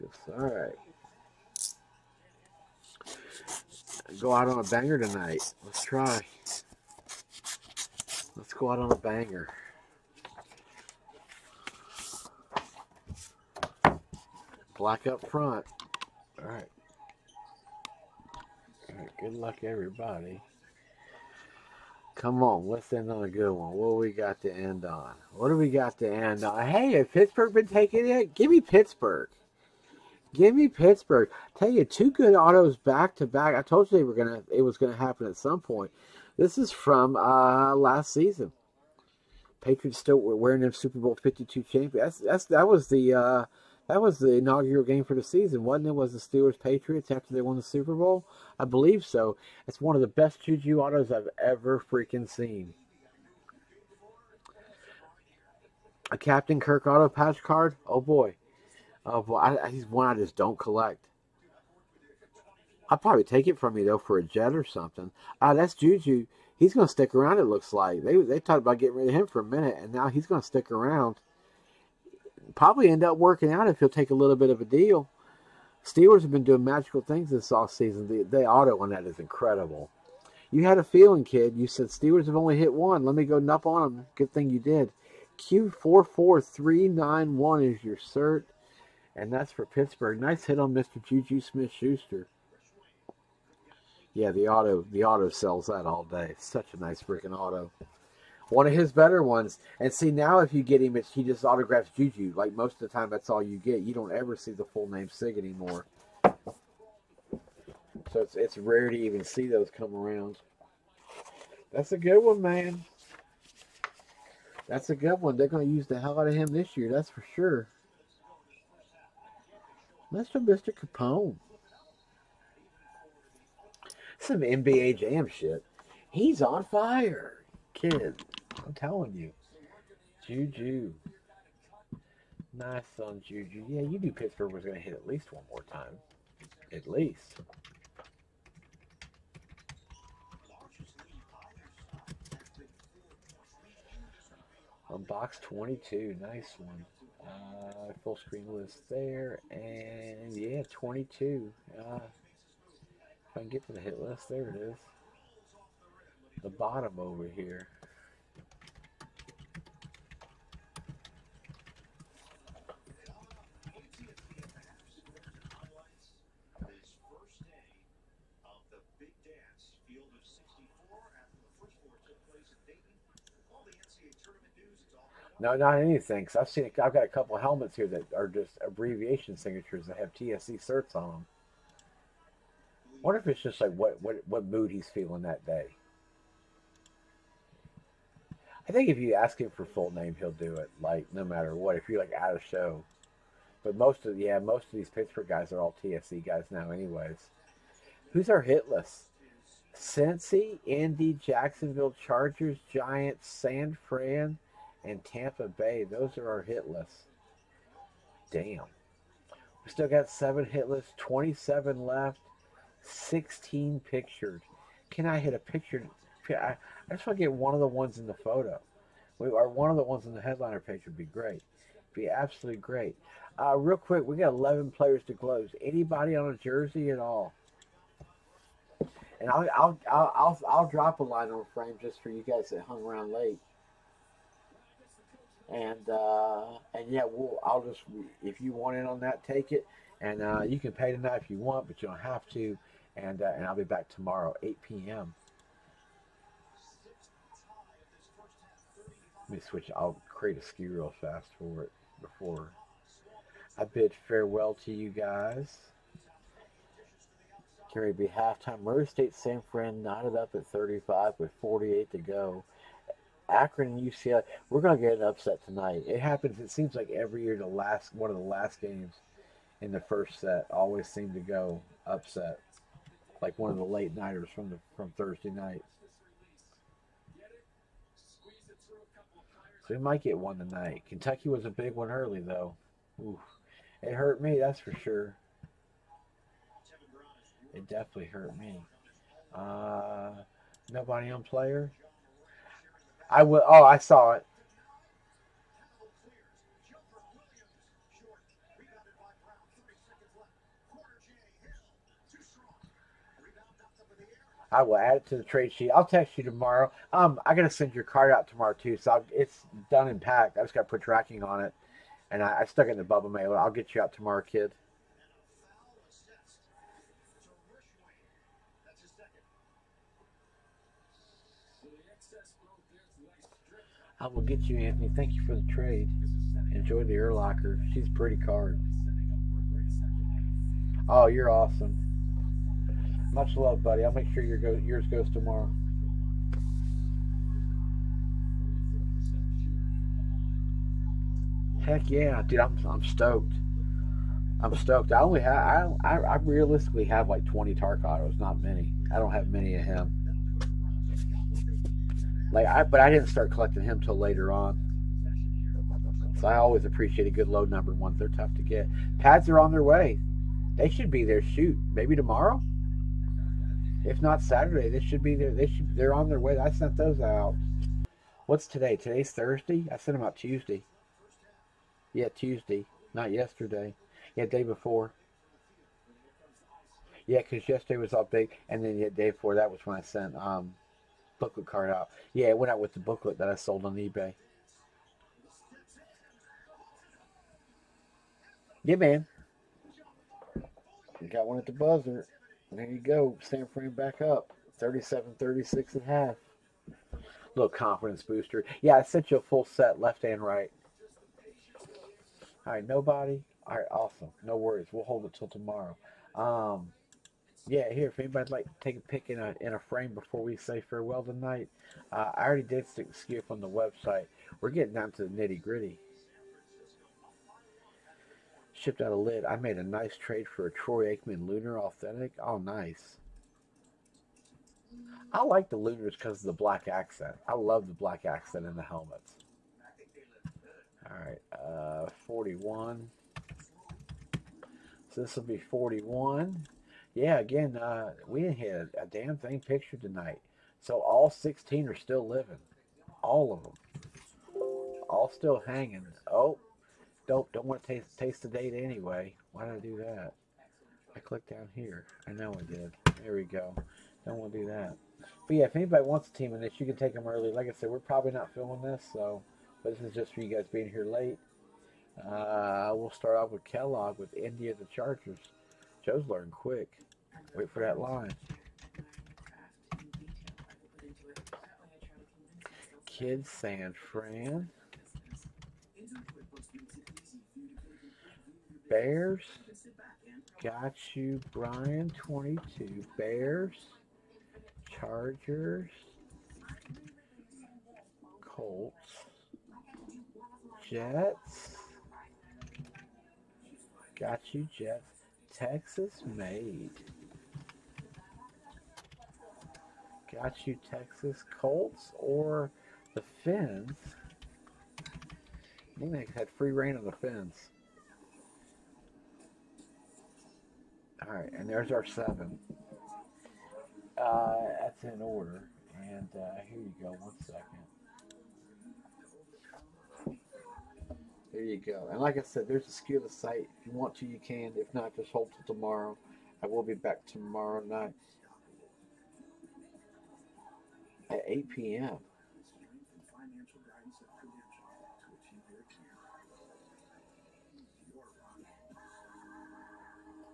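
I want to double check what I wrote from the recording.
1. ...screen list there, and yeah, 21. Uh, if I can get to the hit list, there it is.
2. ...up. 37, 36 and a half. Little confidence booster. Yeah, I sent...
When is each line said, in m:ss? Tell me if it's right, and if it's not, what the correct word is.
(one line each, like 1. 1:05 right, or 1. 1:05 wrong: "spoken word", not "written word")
1. 2:28 wrong: "22", not "21"
2. 6:34 right.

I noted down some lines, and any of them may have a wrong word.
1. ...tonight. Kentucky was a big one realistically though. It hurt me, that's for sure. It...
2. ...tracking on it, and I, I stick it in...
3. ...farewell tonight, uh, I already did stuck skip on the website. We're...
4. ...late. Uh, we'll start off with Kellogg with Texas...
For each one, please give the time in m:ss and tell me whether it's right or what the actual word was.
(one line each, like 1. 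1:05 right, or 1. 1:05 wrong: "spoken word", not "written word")
1. 4:40 wrong: "early", not "realistically"
2. 5:10 wrong: "stuck", not "stick"
3. 6:50 wrong: "stick", not "stuck"
4. 7:40 wrong: "India", not "Texas".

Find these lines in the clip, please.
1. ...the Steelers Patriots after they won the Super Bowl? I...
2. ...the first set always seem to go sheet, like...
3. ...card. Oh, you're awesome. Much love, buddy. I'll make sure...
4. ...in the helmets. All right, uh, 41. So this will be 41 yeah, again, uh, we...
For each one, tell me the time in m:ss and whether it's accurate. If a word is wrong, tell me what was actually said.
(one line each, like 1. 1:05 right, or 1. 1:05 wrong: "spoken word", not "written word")
1. 0:46 right
2. 4:29 wrong: "upset", not "sheet"
3. 5:28 right
4. 7:08 right.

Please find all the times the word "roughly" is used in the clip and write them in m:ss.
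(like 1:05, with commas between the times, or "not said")
not said.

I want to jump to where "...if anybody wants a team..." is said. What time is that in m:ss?
7:35.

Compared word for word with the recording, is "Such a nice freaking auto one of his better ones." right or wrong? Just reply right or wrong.
right.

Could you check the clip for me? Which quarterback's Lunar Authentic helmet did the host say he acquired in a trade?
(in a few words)
Troy Aikman.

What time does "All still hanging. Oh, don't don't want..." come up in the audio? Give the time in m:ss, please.
7:24.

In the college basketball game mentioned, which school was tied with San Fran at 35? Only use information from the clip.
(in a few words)
Murray State.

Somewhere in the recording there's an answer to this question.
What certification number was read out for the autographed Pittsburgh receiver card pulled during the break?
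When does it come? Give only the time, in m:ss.
1:25.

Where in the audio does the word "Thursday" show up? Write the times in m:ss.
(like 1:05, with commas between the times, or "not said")
4:34, 6:09.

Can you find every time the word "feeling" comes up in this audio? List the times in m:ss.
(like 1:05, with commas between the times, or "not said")
1:20, 3:04.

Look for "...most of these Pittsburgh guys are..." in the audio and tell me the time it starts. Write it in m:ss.
3:14.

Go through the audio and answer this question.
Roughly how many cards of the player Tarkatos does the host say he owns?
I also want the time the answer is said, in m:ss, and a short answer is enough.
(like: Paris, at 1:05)
20, at 5:47.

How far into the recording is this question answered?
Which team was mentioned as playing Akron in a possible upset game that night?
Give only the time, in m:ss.
4:23.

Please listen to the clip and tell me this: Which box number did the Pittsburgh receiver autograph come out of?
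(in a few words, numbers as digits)
22.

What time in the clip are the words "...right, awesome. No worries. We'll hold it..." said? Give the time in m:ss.
6:43.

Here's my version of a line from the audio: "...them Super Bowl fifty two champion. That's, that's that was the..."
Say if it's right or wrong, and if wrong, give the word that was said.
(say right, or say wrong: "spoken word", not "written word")
right.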